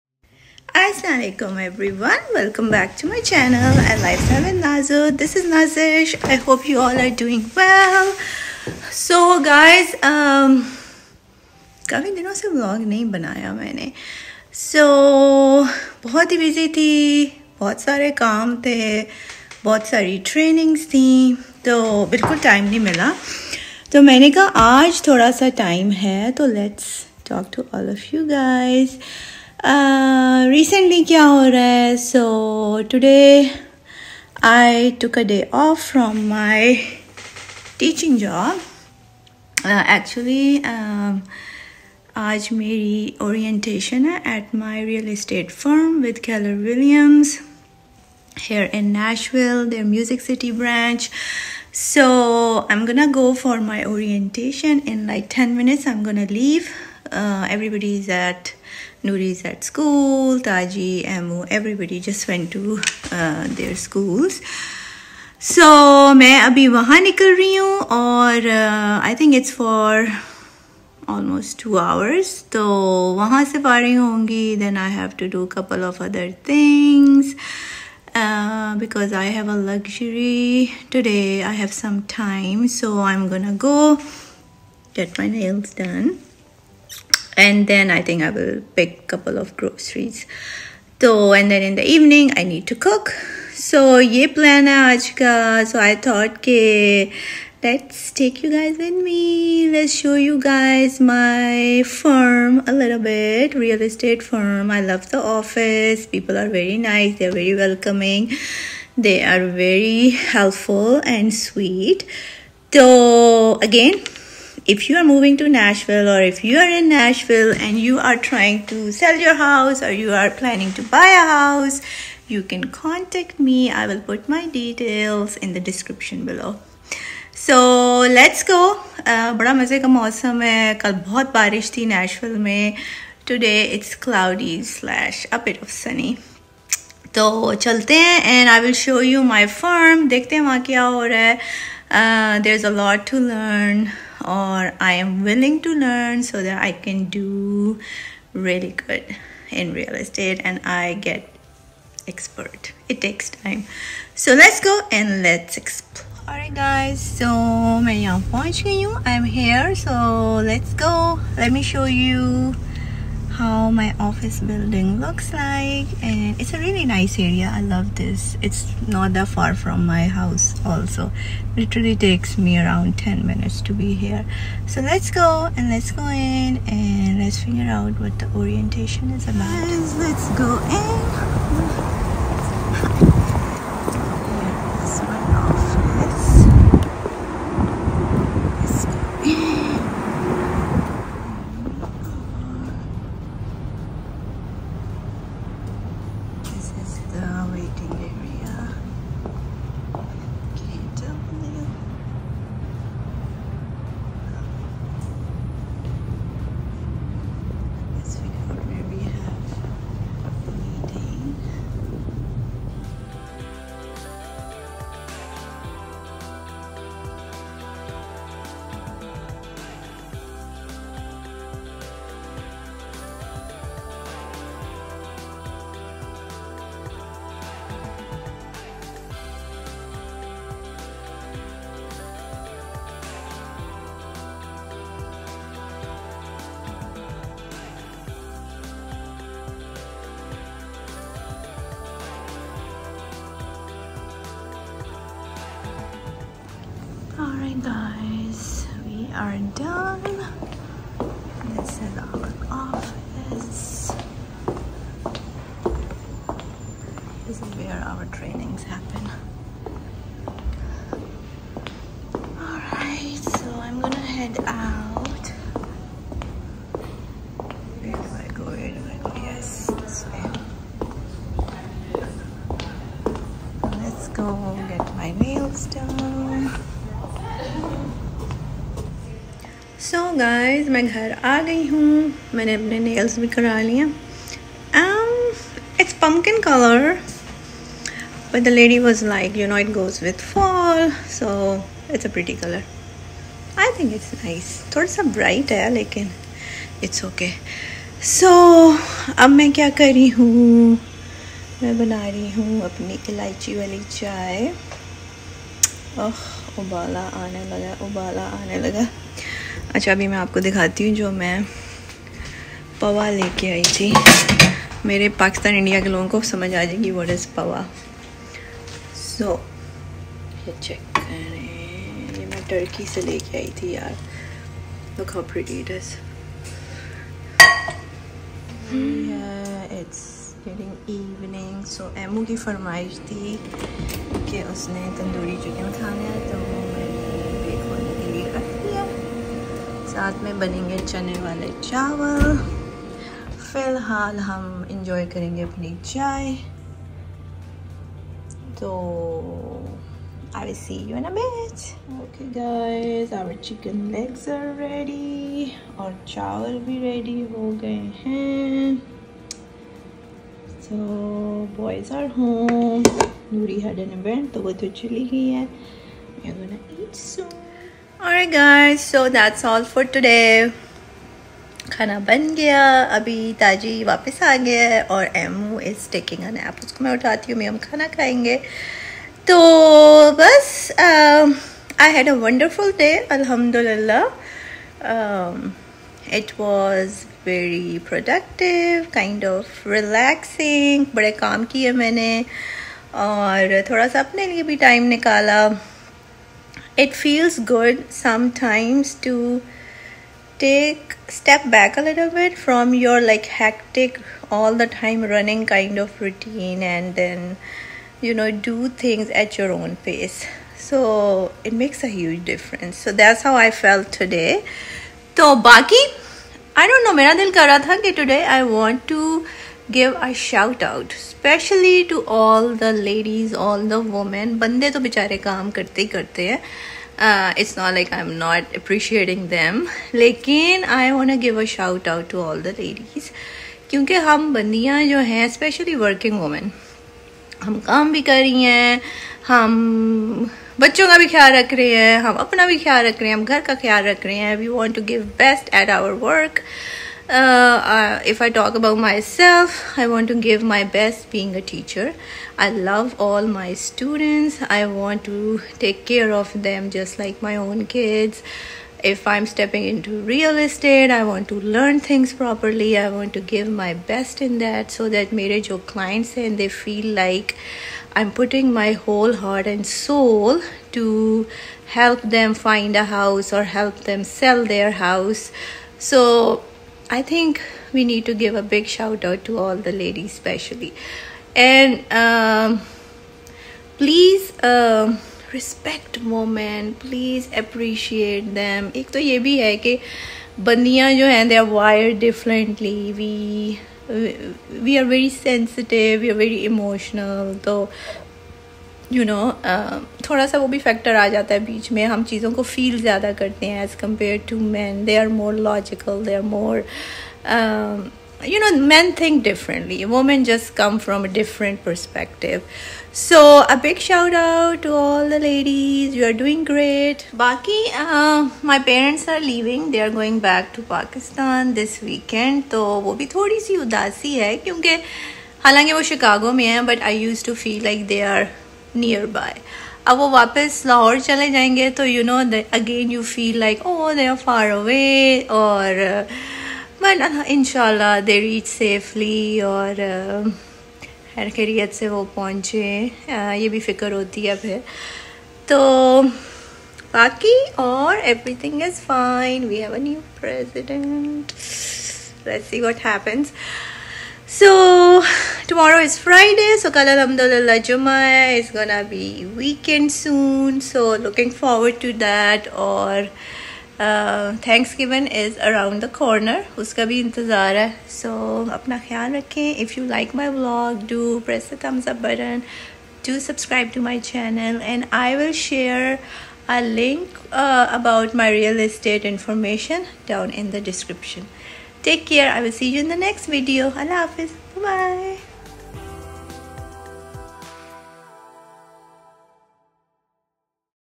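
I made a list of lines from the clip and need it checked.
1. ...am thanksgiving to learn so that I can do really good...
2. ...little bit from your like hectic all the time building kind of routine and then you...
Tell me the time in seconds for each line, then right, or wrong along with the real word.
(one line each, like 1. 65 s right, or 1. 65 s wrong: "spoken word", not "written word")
1. 144 s wrong: "willing", not "thanksgiving"
2. 401 s wrong: "running", not "building".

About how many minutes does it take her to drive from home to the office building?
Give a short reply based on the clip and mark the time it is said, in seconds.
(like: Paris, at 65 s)
10 minutes, at 172 s.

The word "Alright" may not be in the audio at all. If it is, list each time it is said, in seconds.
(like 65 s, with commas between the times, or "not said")
156 s, 247 s.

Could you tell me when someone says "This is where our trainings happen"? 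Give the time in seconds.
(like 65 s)
257 s.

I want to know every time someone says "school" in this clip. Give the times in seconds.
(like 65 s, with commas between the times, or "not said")
59 s, 63 s.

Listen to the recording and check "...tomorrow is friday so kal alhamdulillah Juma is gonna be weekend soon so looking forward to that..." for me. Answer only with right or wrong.
right.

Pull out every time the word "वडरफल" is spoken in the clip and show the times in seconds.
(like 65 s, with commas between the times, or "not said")
382 s.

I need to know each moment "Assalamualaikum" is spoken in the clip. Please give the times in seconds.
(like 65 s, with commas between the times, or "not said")
0 s.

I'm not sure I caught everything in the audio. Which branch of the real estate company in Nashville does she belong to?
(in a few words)
Music City.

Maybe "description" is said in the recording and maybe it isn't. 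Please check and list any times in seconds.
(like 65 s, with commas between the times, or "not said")
125 s, 580 s.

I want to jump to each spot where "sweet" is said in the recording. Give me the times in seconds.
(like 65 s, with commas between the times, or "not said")
111 s.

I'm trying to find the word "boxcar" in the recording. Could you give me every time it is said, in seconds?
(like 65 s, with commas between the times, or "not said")
not said.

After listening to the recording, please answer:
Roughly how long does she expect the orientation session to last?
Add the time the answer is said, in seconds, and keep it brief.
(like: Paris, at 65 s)
two hours, at 71 s.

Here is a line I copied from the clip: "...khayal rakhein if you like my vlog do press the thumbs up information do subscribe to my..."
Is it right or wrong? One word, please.
wrong.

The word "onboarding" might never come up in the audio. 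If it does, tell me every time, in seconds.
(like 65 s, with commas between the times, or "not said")
not said.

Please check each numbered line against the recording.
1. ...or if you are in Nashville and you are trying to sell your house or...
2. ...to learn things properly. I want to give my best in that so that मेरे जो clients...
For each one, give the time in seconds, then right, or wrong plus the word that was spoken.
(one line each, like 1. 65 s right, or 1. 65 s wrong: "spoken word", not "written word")
1. 116 s right
2. 461 s right.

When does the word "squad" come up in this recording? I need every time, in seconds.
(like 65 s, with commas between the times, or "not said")
not said.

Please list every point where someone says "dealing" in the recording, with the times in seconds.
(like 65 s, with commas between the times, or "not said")
not said.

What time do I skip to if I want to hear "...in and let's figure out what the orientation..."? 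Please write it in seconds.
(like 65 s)
176 s.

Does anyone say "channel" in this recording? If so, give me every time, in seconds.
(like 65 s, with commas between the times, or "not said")
3 s, 574 s.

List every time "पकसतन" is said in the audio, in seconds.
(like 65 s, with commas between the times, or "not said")
315 s, 520 s.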